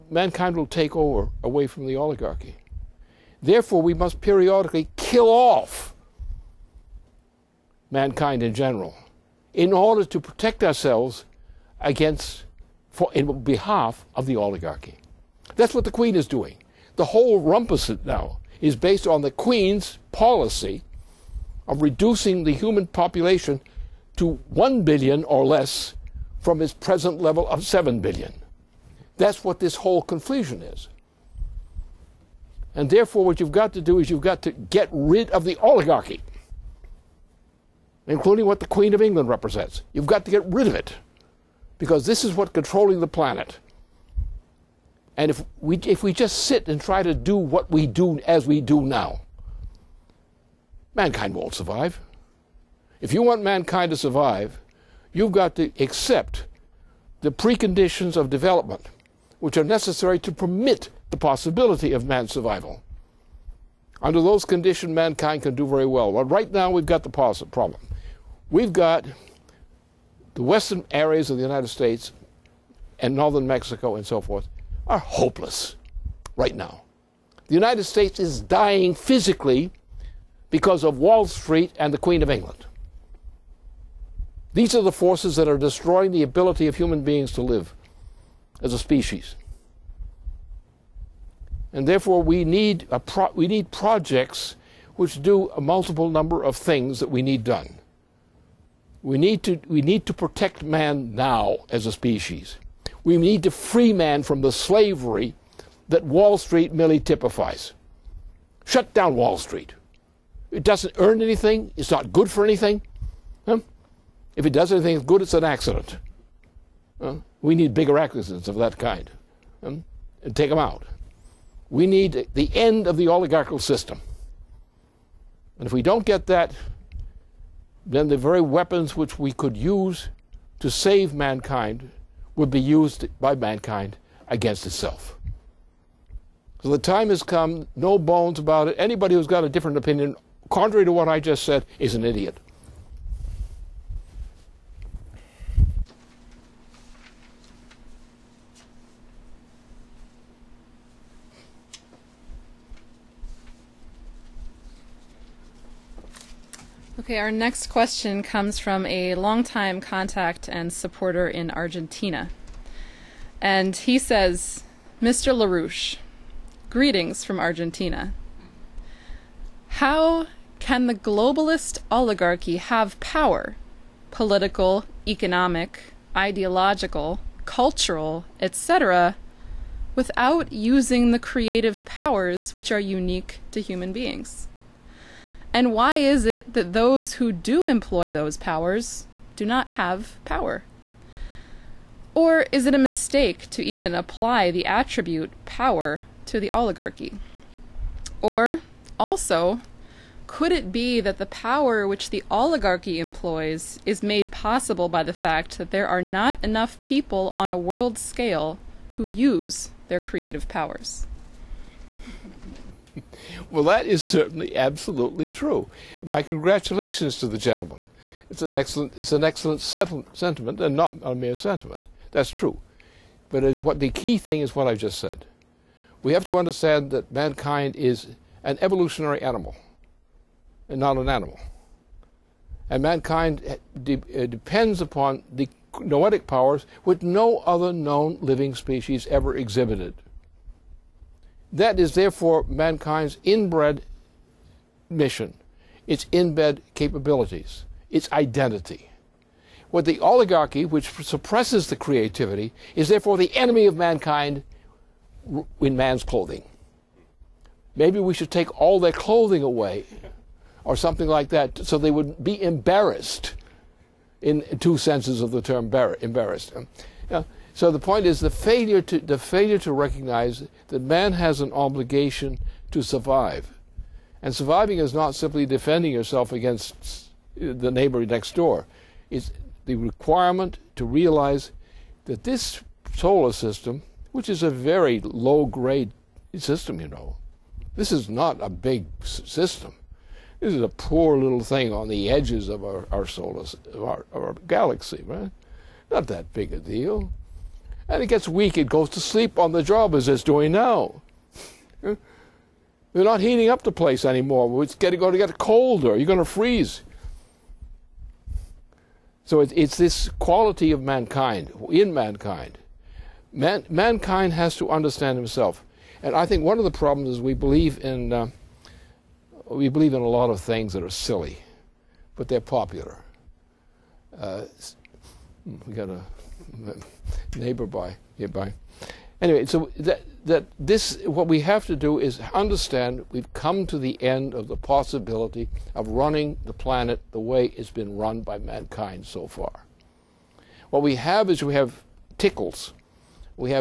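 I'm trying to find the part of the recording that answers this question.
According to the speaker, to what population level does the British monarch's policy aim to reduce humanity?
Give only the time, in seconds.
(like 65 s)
24 s.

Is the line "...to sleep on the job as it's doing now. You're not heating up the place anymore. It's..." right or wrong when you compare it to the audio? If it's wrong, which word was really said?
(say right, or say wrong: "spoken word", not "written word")
right.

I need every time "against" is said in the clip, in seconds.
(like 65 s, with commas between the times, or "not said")
11 s, 134 s, 276 s.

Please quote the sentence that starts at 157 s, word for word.
Okay, our next question comes from a longtime contact and supporter in Argentina.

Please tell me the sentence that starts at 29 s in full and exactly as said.
That's what this whole confusion is.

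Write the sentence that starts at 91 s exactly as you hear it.
And therefore, we need, pro- we need projects which do a multiple number of things that we need done.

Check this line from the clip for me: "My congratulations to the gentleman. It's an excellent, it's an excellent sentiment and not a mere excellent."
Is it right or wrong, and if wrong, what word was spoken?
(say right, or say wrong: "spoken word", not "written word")
wrong: "sentiment", not "excellent".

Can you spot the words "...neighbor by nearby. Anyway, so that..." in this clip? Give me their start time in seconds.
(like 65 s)
327 s.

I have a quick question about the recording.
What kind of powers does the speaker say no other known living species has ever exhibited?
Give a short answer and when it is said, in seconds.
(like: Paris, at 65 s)
noetic powers, at 235 s.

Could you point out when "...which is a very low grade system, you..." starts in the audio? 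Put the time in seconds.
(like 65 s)
284 s.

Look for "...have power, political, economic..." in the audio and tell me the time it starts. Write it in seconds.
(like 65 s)
172 s.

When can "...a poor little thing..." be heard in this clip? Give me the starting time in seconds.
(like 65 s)
290 s.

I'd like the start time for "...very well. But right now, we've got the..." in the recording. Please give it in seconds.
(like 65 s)
65 s.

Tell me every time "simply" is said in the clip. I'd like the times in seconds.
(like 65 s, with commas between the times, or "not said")
275 s.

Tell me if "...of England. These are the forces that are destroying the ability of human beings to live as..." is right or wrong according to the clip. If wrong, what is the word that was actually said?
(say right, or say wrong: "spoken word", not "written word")
right.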